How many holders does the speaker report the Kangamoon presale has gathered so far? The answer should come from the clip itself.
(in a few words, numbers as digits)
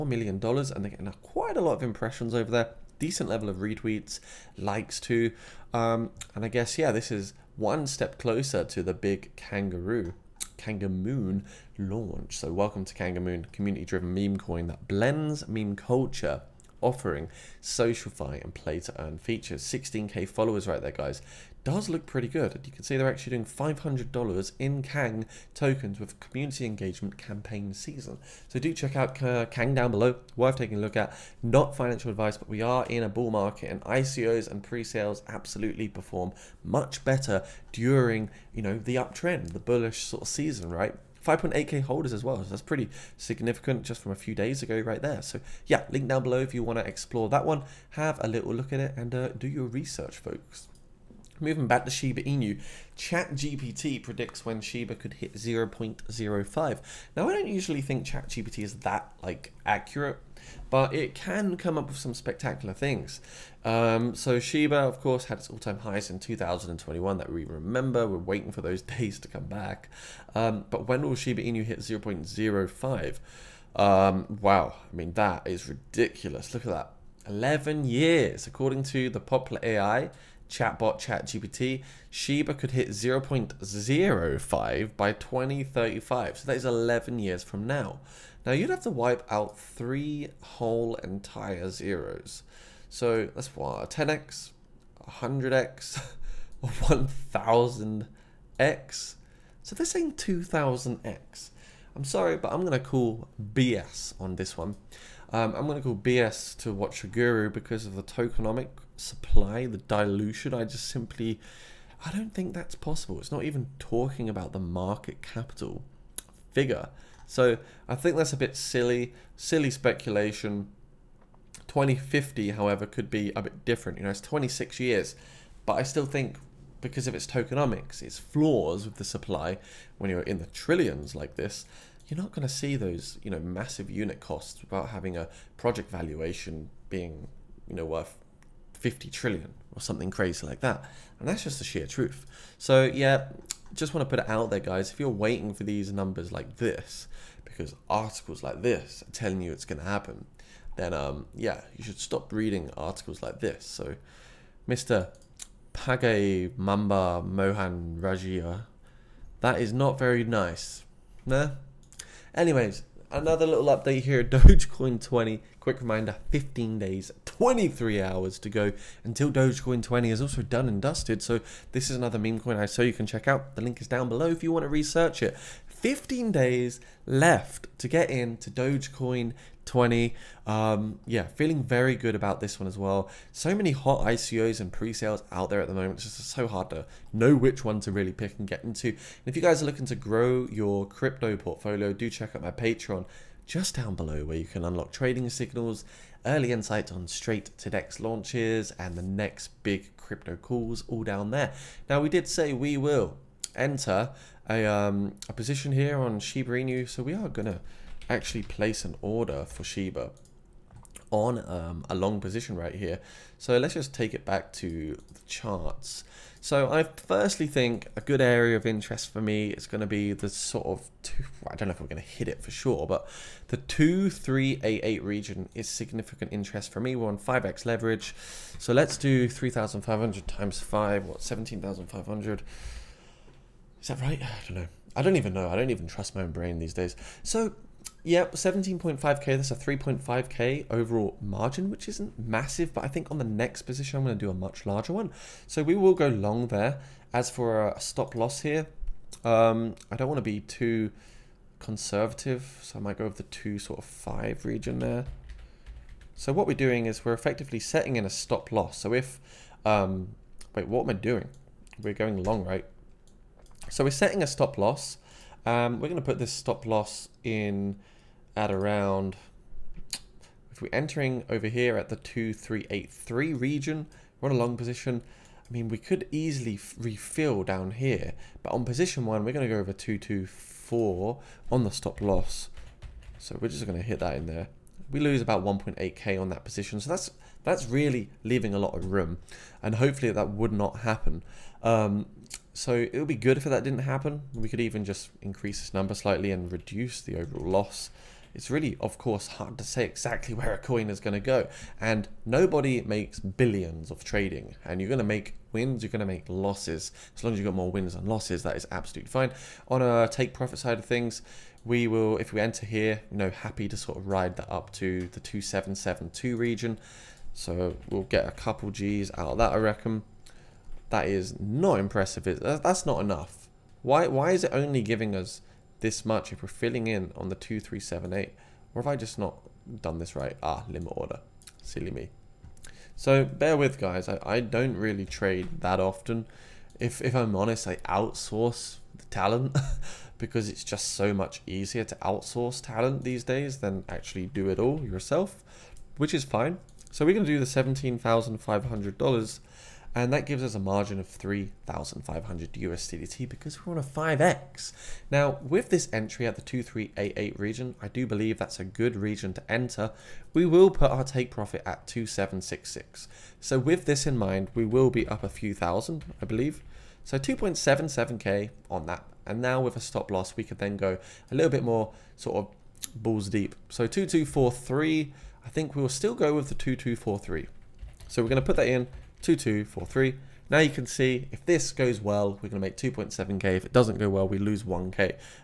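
5.8k.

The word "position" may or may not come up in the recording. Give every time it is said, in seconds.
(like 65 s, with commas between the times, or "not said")
205 s, 212 s, 243 s, 274 s, 278 s, 286 s.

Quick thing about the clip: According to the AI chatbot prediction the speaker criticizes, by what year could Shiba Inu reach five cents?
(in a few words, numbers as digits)
2035.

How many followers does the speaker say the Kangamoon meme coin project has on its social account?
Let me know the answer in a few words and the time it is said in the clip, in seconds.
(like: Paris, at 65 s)
16k, at 19 s.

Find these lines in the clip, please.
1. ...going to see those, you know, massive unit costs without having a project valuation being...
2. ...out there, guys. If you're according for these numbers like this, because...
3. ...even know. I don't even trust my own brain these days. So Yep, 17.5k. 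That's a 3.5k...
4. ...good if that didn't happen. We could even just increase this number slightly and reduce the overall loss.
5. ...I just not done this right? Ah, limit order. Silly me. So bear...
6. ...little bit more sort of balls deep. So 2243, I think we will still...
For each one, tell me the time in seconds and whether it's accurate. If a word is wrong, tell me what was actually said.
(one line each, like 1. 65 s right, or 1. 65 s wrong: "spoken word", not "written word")
1. 132 s right
2. 144 s wrong: "waiting", not "according"
3. 235 s right
4. 293 s right
5. 328 s right
6. 371 s right.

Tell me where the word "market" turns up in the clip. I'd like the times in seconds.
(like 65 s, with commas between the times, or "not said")
33 s, 114 s.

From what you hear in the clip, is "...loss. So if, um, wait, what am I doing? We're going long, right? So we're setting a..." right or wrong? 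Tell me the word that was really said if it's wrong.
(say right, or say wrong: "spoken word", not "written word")
right.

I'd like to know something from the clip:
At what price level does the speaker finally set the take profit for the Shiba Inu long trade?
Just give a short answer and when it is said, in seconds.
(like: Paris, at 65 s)
2766, at 361 s.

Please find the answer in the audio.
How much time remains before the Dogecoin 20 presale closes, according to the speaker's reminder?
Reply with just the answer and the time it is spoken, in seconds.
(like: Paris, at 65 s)
15 days, 23 hours, at 166 s.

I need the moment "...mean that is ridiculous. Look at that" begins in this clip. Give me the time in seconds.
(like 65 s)
74 s.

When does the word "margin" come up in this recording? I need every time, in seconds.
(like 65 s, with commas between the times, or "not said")
241 s, 350 s.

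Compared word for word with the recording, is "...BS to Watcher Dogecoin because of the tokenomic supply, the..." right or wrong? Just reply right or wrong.
wrong.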